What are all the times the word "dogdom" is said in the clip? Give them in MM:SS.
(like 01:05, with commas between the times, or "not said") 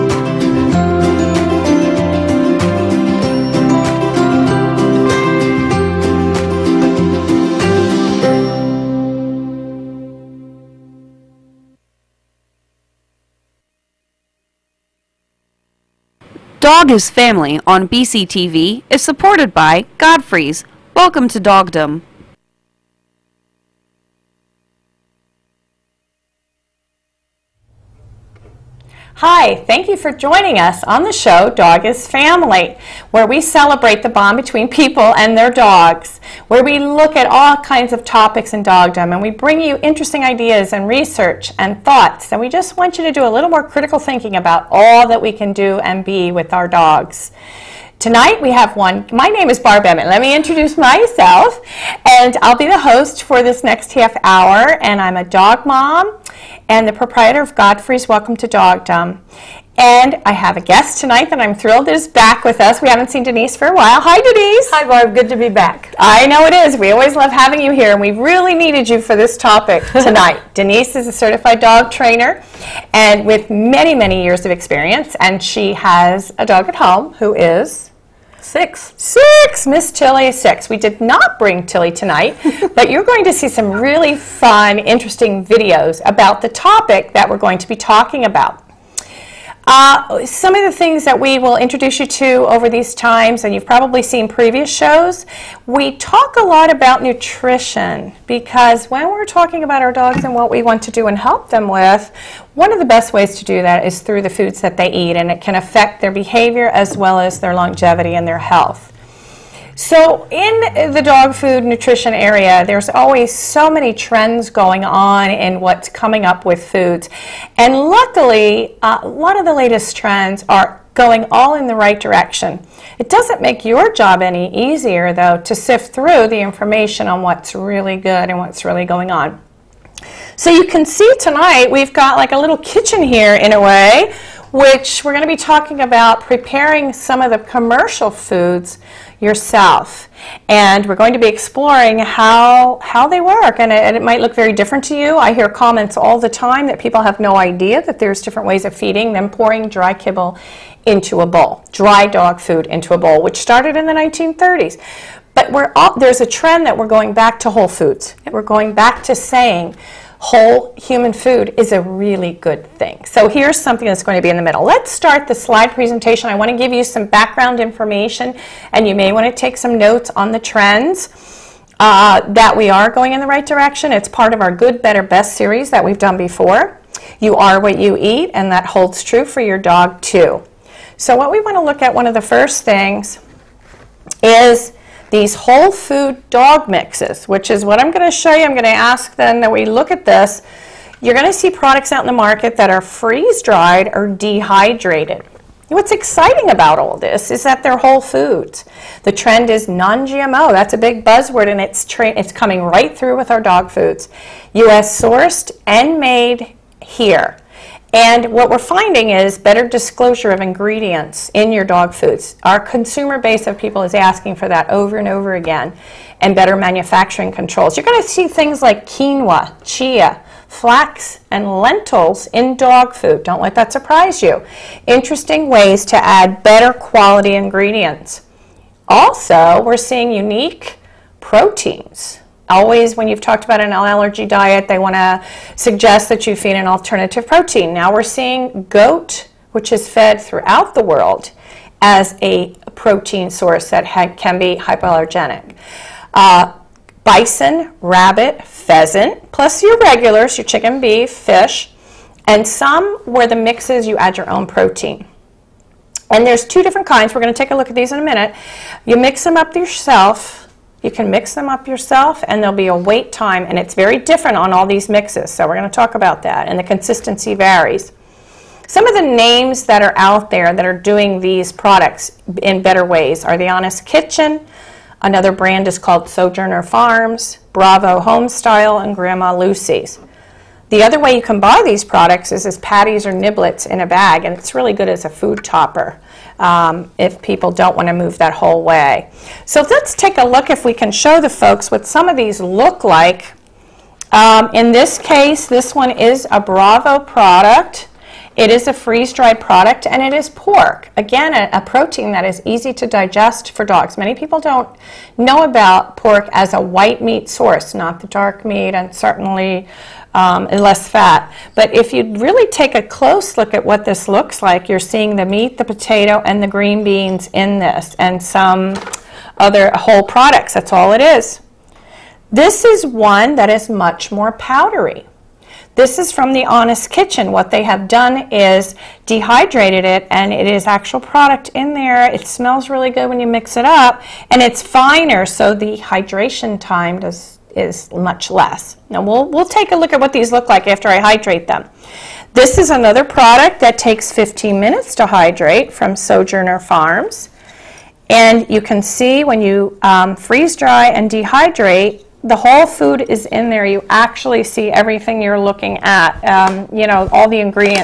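00:21, 00:38, 00:58.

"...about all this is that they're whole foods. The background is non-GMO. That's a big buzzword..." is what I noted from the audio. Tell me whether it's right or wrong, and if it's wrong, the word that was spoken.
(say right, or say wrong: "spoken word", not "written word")
wrong: "trend", not "background".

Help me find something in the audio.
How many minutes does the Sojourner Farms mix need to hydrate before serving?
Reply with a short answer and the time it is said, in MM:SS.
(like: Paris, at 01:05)
15, at 05:44.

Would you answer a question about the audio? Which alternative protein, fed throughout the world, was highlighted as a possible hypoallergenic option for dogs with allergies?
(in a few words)
Goat.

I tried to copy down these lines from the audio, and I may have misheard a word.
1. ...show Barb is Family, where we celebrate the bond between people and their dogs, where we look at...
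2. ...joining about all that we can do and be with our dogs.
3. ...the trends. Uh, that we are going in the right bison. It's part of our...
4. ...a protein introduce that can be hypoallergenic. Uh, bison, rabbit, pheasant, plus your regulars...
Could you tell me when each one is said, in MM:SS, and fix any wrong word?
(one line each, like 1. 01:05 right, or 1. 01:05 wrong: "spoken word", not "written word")
1. 00:31 wrong: "Dog", not "Barb"
2. 00:44 wrong: "thinking", not "joining"
3. 02:50 wrong: "direction", not "bison"
4. 04:02 wrong: "source", not "introduce".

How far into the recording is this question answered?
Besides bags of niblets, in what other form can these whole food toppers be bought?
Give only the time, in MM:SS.
04:42.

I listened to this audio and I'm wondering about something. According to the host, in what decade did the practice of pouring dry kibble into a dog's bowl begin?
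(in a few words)
1930s.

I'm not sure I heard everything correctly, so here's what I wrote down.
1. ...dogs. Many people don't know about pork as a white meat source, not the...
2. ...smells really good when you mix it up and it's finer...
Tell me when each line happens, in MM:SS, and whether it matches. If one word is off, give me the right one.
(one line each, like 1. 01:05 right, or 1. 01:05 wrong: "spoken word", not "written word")
1. 05:03 right
2. 05:32 right.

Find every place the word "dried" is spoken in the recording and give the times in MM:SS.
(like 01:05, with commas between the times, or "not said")
03:13, 04:58.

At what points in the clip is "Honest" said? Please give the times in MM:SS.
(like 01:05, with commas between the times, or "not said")
04:33, 05:26.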